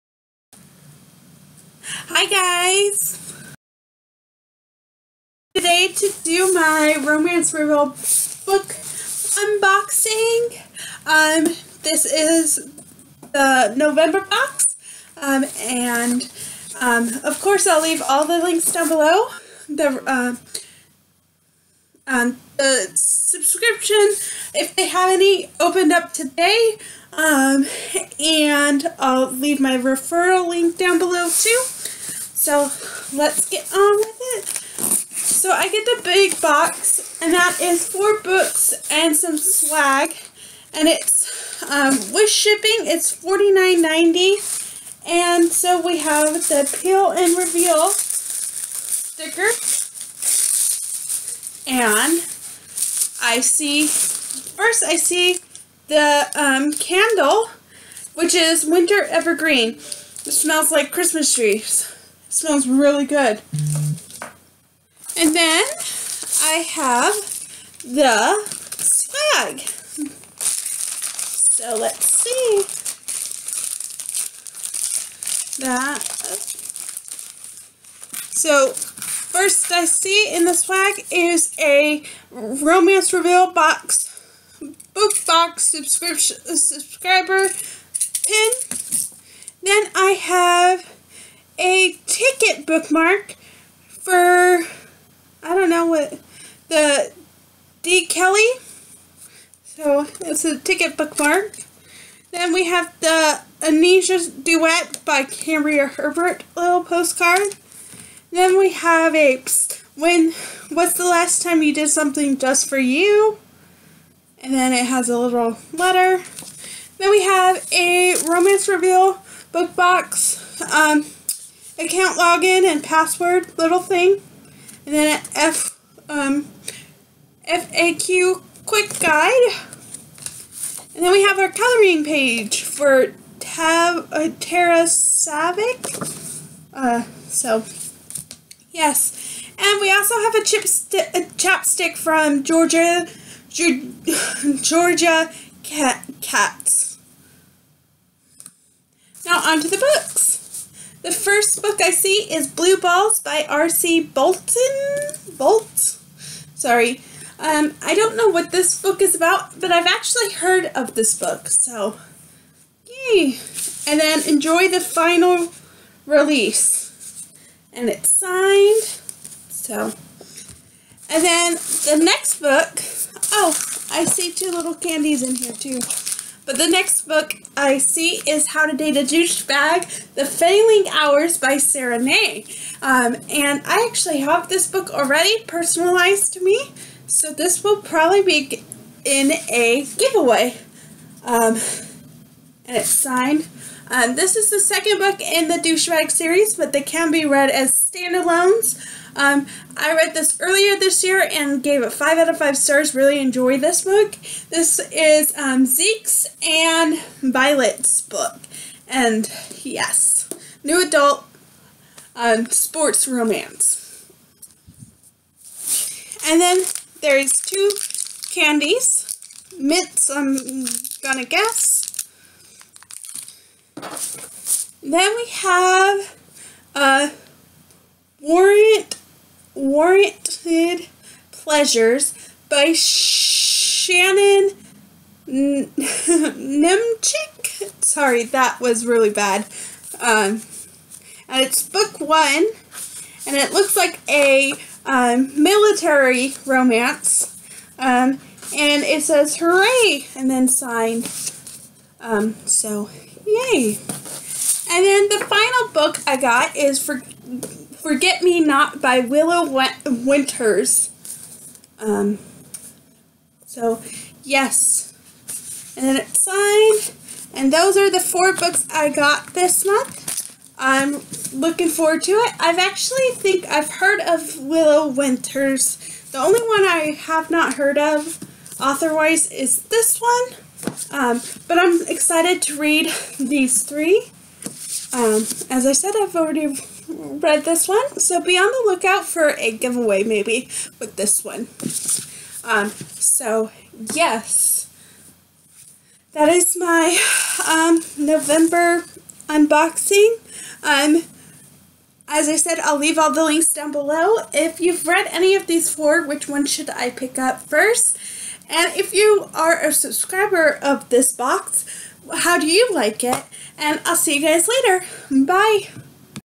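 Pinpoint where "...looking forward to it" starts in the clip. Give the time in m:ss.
4:31.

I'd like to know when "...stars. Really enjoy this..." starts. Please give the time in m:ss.
3:22.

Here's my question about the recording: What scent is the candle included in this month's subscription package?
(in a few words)
Winter Evergreen.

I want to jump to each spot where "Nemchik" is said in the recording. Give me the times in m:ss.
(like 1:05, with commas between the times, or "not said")
3:55.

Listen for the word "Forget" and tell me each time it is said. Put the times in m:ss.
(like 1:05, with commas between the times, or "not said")
4:17.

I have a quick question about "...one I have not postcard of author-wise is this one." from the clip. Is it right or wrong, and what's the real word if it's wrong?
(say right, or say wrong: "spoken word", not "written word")
wrong: "heard", not "postcard".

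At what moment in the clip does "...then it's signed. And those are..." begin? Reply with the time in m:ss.
4:25.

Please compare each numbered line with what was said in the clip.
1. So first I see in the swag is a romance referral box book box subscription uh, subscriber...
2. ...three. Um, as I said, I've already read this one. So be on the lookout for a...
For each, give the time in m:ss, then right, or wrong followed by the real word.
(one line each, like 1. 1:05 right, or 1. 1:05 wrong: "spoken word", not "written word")
1. 1:18 wrong: "reveal", not "referral"
2. 4:43 right.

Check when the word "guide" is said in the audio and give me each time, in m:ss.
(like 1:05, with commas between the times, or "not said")
2:08.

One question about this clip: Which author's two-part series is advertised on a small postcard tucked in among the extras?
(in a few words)
Cambria Hebert.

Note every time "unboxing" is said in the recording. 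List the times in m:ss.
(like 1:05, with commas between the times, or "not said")
0:09, 4:59.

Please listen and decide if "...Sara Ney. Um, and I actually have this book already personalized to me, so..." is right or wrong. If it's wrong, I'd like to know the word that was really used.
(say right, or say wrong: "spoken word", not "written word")
right.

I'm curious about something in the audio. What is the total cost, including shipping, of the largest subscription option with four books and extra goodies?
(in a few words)
$49.90.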